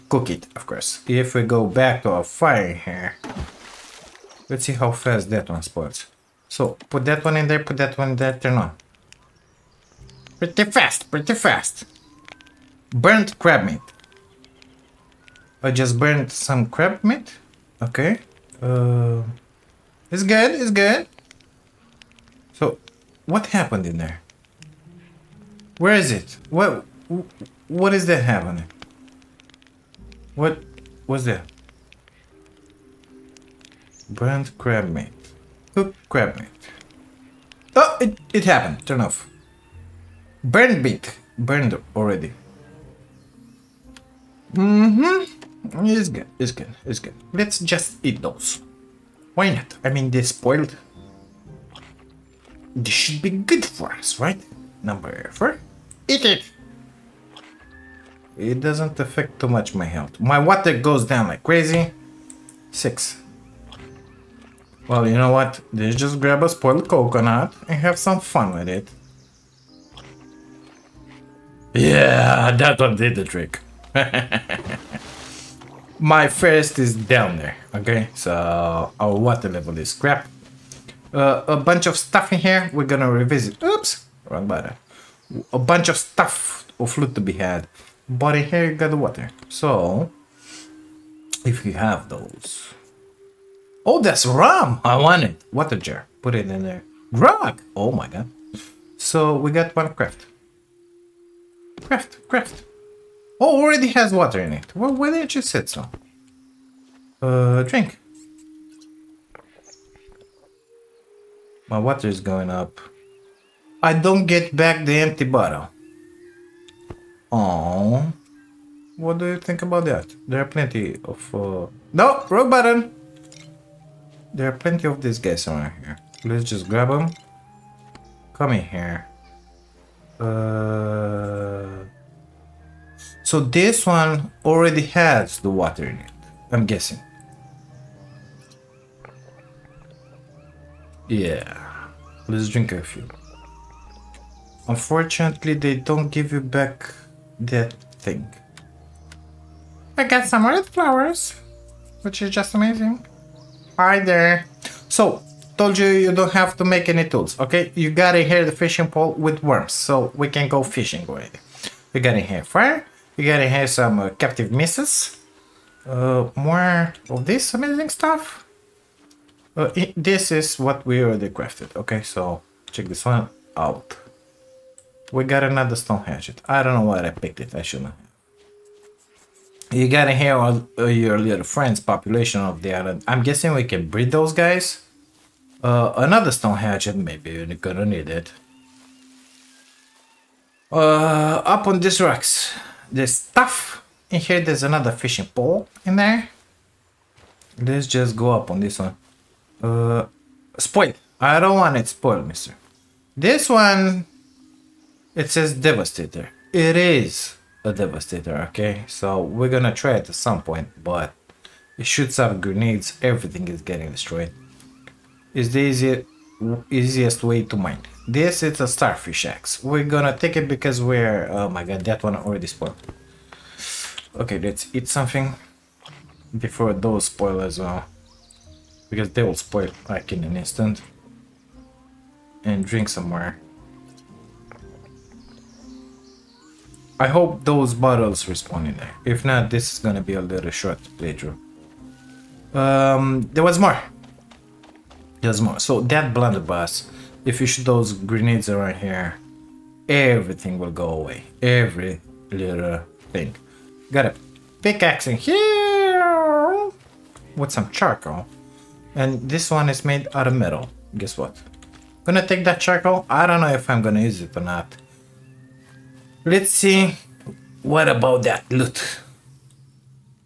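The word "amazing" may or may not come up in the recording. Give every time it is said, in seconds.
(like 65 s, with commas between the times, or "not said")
152 s, 167 s.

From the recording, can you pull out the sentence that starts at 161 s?
We got in here fire, we got gonna have some uh, captive misses.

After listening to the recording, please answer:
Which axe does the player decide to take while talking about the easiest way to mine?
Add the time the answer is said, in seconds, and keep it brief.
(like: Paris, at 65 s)
Starfish axe, at 218 s.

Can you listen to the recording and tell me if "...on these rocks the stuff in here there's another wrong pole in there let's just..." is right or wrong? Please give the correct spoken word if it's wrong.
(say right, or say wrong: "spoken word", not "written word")
wrong: "fishing", not "wrong".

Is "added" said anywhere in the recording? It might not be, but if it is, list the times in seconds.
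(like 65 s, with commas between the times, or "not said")
not said.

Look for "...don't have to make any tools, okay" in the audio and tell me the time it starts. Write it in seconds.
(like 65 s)
156 s.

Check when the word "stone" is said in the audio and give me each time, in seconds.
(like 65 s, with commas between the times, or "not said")
175 s, 186 s.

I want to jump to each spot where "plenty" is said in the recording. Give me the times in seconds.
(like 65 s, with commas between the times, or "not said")
120 s, 124 s.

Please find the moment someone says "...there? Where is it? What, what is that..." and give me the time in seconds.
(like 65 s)
23 s.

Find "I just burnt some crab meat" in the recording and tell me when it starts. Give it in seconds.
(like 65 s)
15 s.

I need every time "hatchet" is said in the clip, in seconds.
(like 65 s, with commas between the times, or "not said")
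176 s, 186 s.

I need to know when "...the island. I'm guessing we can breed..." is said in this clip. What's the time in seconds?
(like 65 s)
182 s.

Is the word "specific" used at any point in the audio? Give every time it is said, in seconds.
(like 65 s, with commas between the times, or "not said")
not said.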